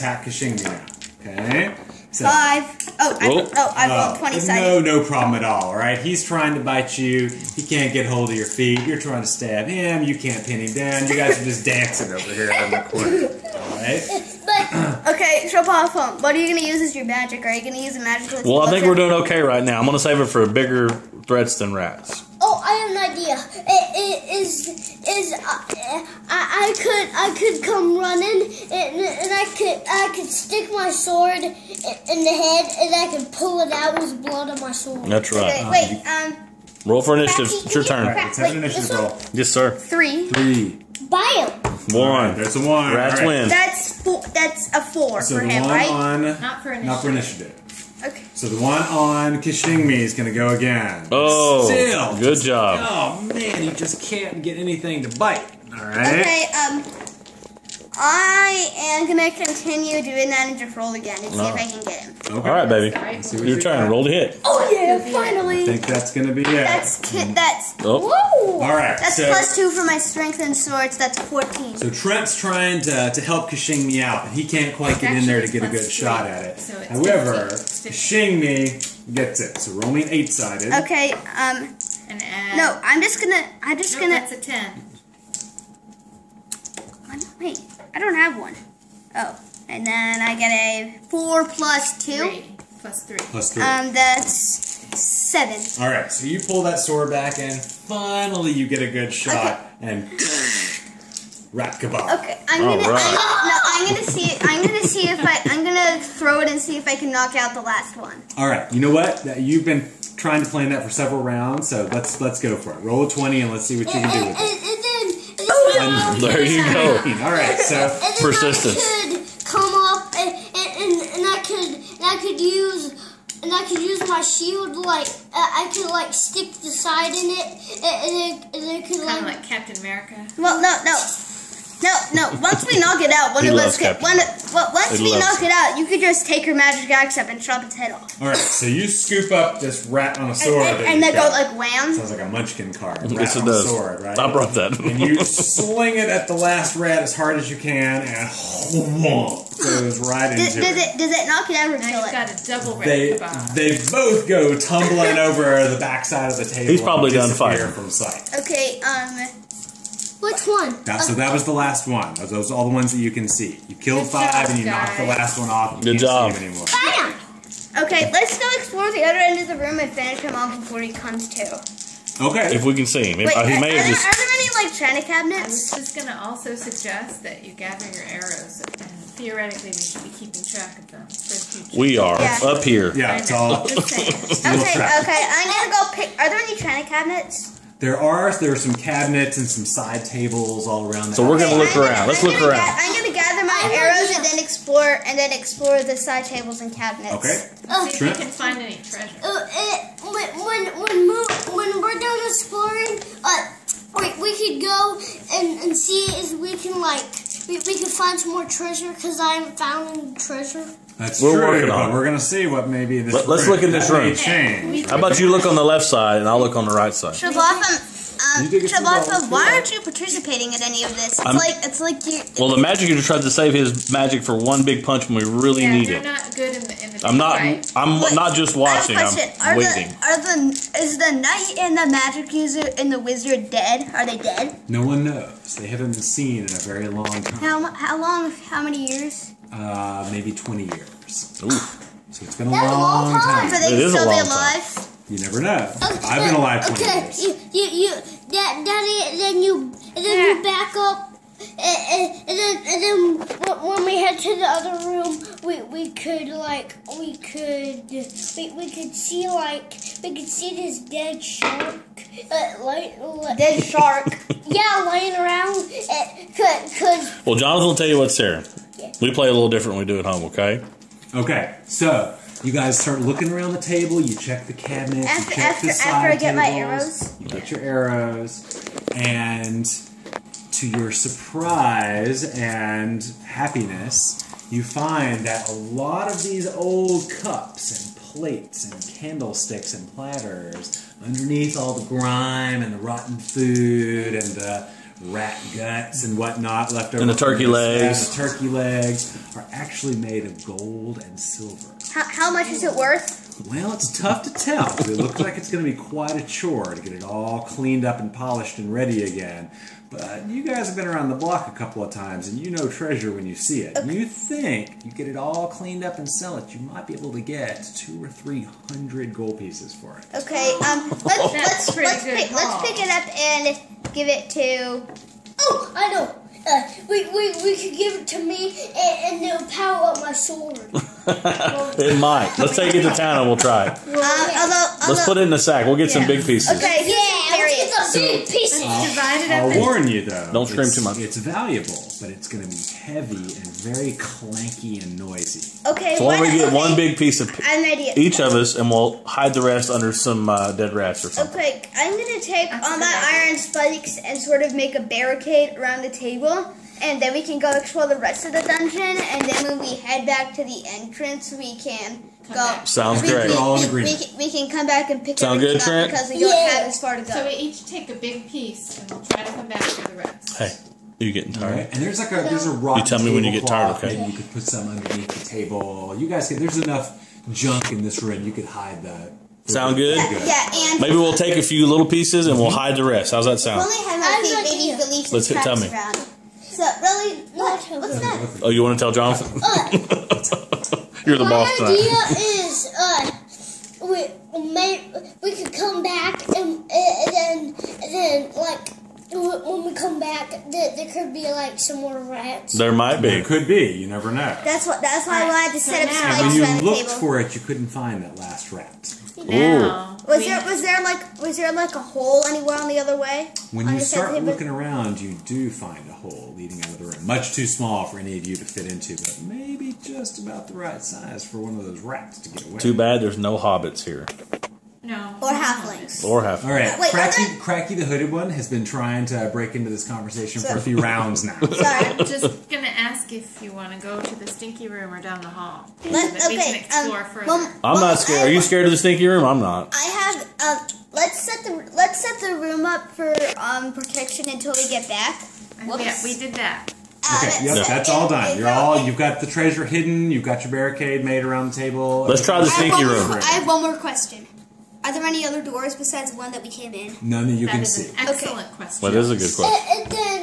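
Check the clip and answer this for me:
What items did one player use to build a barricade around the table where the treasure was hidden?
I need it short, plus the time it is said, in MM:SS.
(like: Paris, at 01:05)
iron spikes, at 05:53.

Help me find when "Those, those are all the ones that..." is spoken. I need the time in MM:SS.
02:42.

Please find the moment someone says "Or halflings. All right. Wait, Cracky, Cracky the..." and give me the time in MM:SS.
07:06.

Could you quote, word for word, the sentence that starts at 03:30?
That's We're true, working on but it.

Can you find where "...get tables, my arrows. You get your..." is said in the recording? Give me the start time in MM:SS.
04:36.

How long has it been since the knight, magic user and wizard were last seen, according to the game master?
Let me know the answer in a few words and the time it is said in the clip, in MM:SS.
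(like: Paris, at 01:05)
20 years, at 04:00.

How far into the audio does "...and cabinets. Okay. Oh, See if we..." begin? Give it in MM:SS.
03:16.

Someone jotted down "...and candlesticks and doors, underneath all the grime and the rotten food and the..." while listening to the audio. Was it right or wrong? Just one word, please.
wrong.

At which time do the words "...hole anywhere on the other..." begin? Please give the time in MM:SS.
06:51.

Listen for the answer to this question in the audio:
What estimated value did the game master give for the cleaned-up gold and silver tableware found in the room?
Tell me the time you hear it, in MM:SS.
05:17.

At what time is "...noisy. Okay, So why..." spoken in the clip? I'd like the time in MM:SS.
05:44.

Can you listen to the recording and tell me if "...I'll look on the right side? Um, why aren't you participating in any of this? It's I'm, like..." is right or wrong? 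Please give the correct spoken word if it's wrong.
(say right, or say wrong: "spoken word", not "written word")
right.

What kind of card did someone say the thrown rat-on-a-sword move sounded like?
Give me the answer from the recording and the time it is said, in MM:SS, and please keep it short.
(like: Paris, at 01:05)
munchkin card, at 02:22.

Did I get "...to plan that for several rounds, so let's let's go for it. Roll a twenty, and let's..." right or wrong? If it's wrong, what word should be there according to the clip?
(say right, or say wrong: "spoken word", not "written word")
right.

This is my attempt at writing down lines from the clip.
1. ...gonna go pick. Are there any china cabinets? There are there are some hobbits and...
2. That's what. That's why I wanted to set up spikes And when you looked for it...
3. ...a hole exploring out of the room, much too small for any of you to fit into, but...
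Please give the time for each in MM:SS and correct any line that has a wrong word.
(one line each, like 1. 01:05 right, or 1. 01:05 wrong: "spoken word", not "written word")
1. 03:05 wrong: "cabinets", not "hobbits"
2. 06:44 right
3. 06:55 wrong: "leading", not "exploring".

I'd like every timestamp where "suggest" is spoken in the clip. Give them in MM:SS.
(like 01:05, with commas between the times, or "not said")
02:56.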